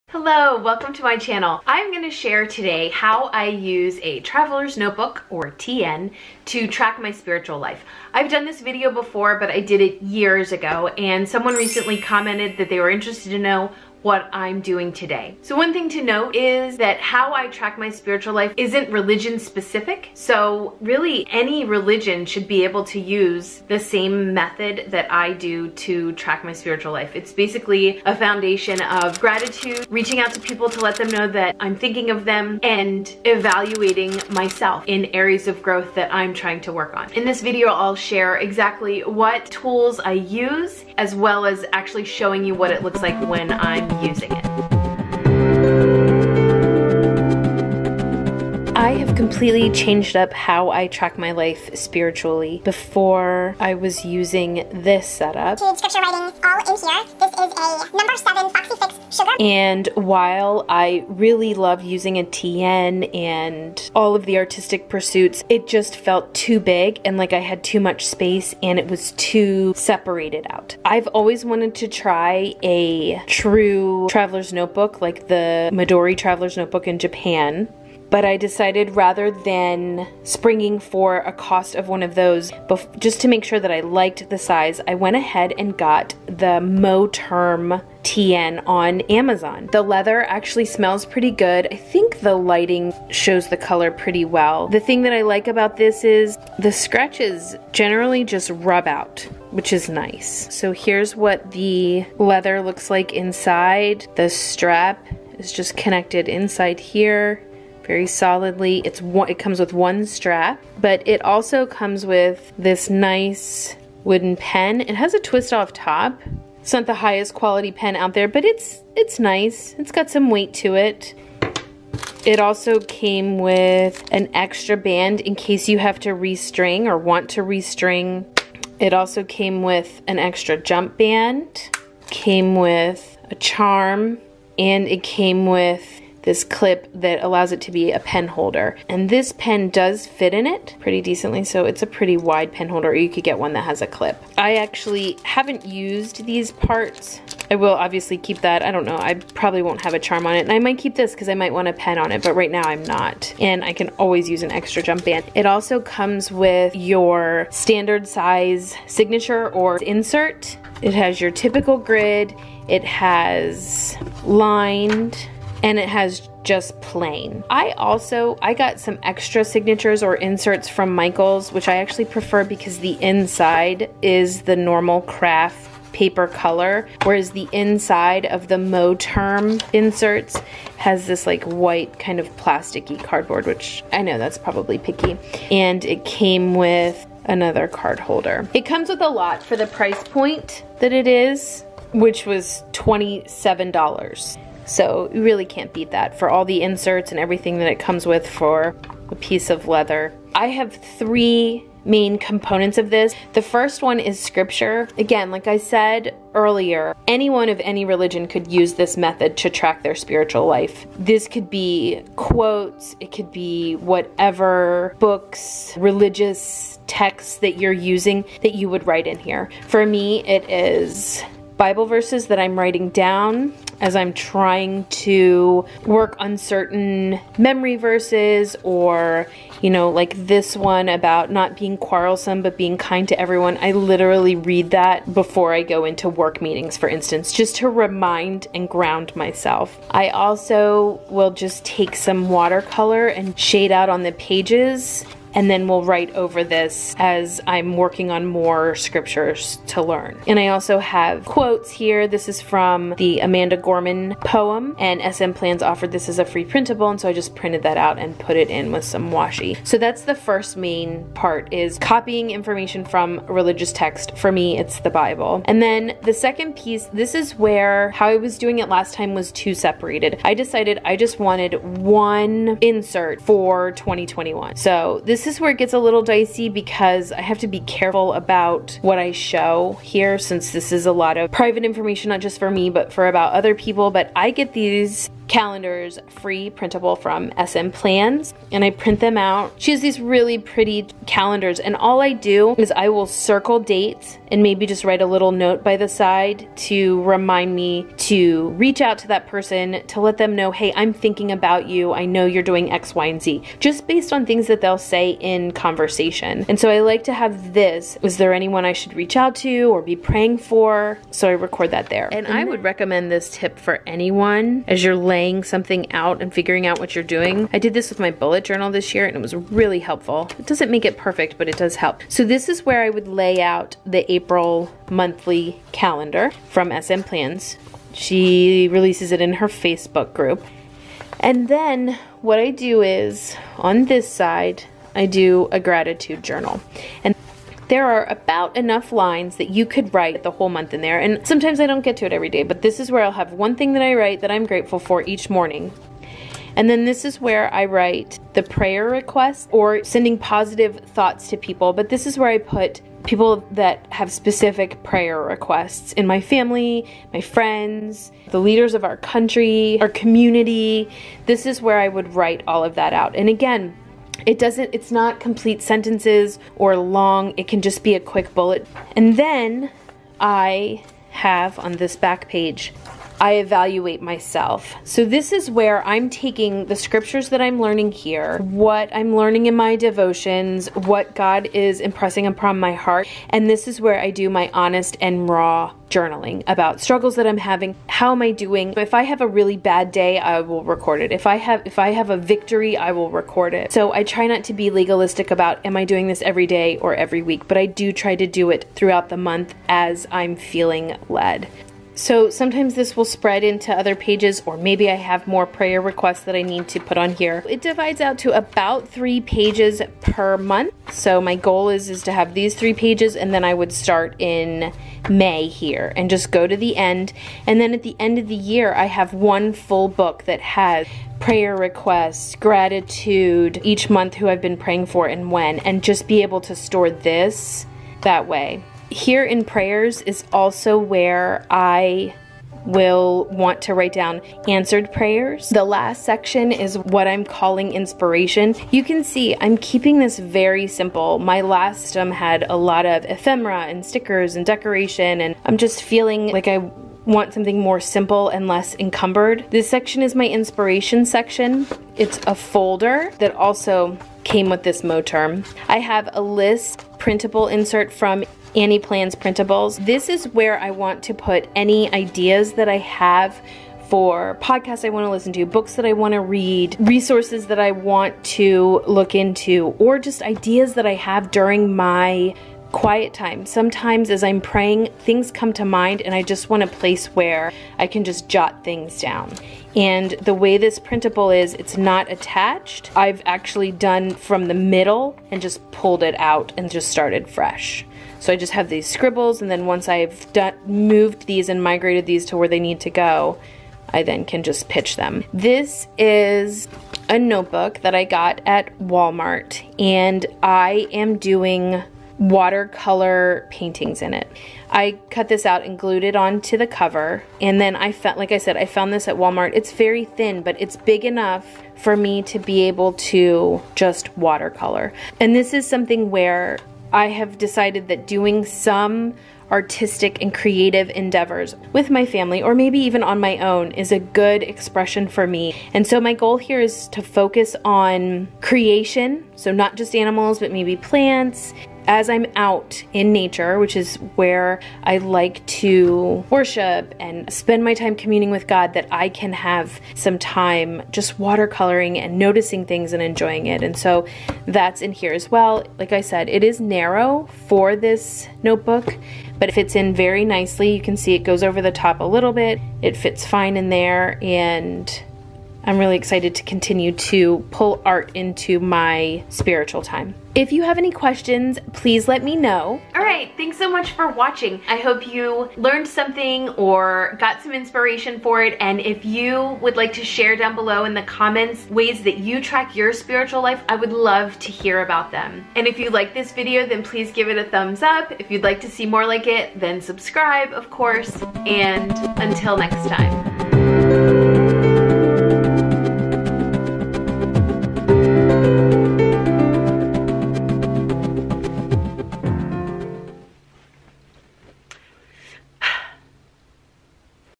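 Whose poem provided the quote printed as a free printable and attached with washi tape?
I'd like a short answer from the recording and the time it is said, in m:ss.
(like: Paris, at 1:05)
Amanda Gorman, at 4:13.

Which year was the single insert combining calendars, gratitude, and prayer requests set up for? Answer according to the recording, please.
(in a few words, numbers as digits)
2021.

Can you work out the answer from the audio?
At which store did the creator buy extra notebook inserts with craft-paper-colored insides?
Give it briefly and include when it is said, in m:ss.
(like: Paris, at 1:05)
Michaels, at 2:50.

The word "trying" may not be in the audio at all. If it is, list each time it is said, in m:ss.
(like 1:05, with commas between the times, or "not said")
0:36, 3:44.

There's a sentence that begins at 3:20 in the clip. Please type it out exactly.
I have three main components of this.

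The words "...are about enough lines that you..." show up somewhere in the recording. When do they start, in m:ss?
5:37.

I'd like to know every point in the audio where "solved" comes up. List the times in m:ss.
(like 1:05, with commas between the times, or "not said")
not said.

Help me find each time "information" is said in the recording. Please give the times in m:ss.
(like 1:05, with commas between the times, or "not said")
4:22, 4:41.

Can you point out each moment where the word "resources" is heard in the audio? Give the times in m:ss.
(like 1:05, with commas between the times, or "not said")
7:46.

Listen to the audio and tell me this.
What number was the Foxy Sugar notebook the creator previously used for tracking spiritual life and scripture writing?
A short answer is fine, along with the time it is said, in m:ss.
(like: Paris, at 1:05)
7, at 0:58.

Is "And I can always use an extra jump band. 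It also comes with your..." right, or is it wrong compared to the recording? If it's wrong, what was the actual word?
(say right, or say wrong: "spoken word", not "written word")
right.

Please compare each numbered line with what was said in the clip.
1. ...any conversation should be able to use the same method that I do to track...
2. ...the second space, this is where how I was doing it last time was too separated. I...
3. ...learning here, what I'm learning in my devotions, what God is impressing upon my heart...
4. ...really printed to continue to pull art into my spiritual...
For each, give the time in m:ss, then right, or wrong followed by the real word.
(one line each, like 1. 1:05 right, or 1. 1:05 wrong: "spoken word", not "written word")
1. 0:21 wrong: "religion", not "conversation"
2. 4:26 wrong: "piece", not "space"
3. 6:17 right
4. 9:15 wrong: "excited", not "printed".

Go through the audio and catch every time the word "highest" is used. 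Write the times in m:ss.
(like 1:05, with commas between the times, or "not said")
1:56.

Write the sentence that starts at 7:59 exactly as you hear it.
And the way this printable is, it's not attached.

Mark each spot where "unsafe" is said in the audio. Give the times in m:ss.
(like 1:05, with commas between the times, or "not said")
not said.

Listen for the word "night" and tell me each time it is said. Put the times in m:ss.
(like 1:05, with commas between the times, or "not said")
not said.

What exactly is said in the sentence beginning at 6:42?
So sometimes this will spread into other pages or maybe I have more prayer requests that I need to put on here.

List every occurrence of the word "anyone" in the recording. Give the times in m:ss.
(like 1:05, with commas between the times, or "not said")
3:27, 5:08, 5:13.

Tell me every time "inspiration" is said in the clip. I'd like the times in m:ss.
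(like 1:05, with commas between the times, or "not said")
7:17, 7:30, 9:27.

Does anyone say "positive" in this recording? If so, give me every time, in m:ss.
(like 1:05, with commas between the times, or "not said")
5:50.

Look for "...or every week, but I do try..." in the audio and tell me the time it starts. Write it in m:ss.
6:36.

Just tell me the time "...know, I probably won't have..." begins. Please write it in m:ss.
2:28.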